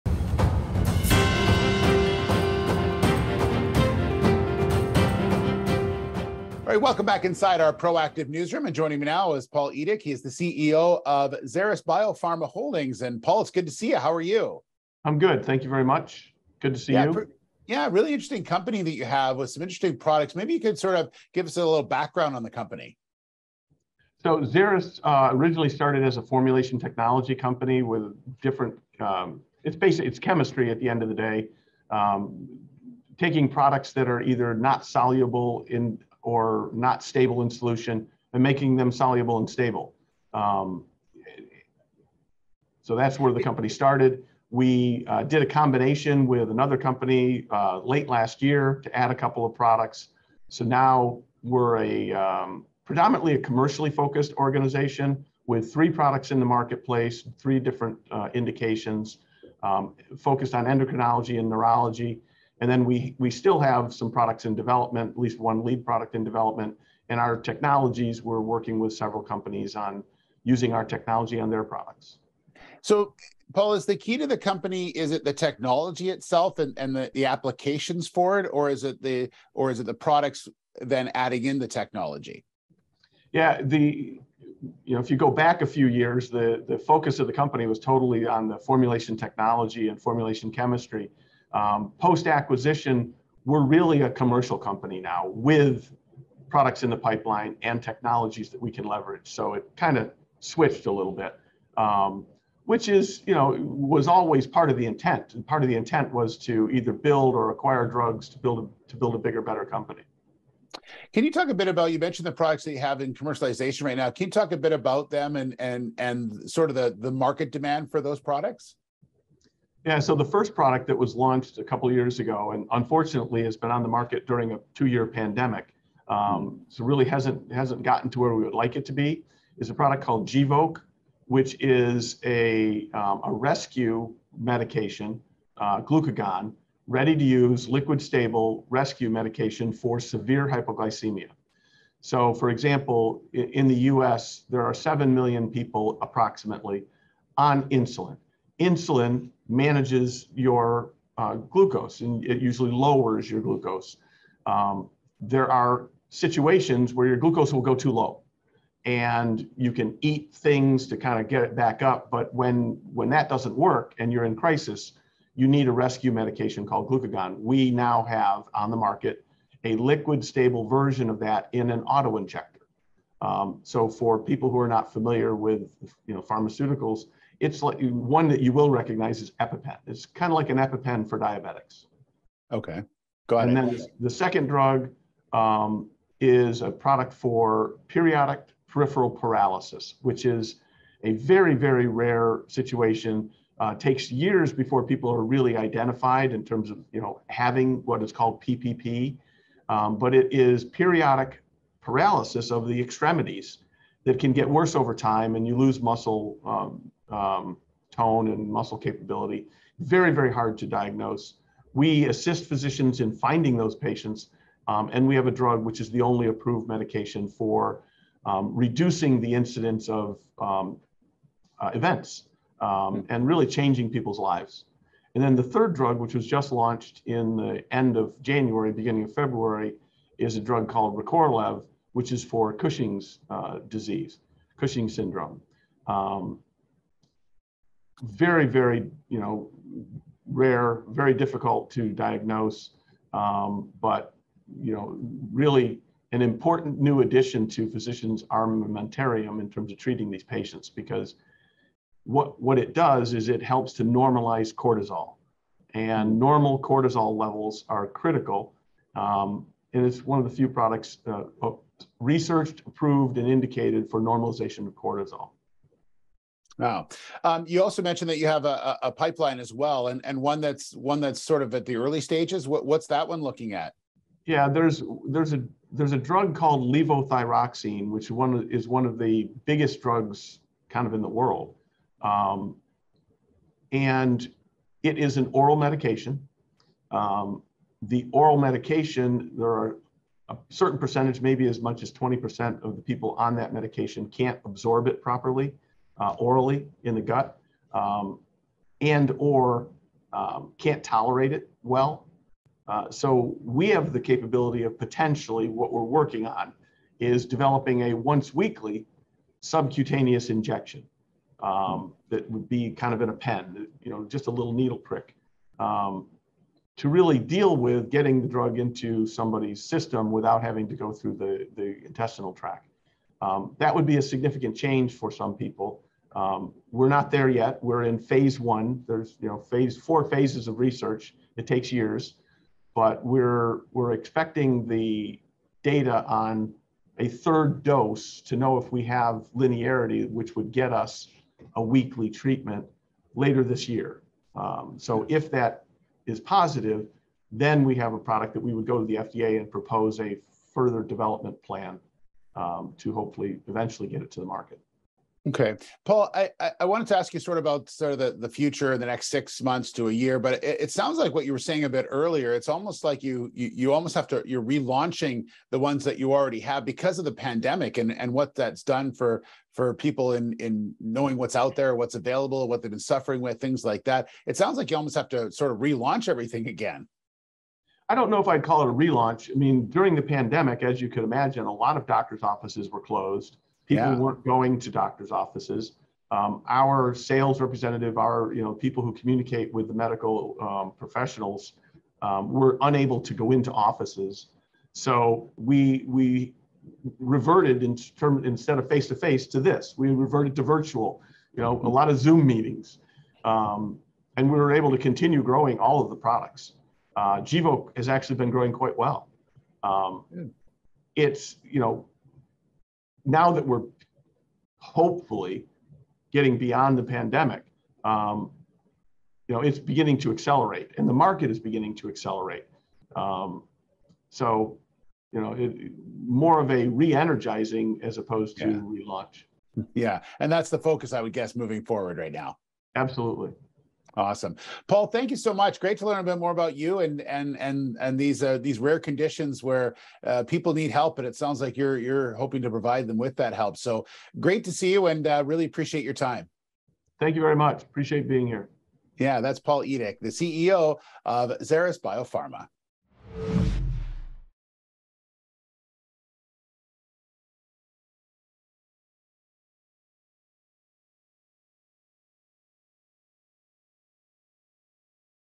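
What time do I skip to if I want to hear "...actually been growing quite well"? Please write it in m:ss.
6:47.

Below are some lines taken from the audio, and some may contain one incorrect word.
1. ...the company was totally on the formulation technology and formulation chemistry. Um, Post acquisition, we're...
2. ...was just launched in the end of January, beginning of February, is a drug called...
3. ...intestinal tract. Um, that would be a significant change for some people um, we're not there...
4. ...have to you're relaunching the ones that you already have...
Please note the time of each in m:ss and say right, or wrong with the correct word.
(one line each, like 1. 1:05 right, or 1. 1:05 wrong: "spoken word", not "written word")
1. 1:27 right
2. 3:46 right
3. 5:21 right
4. 6:03 right.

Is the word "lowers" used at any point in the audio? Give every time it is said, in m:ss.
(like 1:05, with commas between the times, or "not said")
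2:32.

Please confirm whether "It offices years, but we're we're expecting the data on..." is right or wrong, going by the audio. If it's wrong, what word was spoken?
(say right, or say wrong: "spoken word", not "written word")
wrong: "takes", not "offices".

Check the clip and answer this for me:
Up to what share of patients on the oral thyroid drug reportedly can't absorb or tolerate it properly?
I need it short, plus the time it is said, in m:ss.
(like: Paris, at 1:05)
20%, at 4:51.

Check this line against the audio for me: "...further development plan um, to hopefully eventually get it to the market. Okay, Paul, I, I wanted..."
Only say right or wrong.
right.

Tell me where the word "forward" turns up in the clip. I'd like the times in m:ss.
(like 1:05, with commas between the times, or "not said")
7:11.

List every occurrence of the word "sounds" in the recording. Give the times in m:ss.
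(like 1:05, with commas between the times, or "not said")
6:00, 6:14, 7:21.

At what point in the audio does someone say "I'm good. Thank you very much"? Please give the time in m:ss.
0:15.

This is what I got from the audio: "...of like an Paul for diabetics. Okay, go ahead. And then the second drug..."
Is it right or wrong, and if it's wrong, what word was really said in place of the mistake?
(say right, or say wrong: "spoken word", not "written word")
wrong: "EpiPen", not "Paul".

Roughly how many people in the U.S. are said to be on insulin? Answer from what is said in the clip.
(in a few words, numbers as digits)
7 million.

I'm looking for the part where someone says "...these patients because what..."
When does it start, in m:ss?
4:10.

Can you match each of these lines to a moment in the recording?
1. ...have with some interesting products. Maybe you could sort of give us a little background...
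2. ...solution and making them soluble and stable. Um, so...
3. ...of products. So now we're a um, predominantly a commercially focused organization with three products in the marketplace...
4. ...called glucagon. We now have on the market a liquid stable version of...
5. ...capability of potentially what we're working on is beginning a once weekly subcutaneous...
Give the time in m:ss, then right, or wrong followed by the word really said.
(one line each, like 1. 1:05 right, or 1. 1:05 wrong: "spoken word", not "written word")
1. 0:19 right
2. 0:37 right
3. 0:49 right
4. 2:46 right
5. 5:03 wrong: "developing", not "beginning".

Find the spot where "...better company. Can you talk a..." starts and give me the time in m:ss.
1:49.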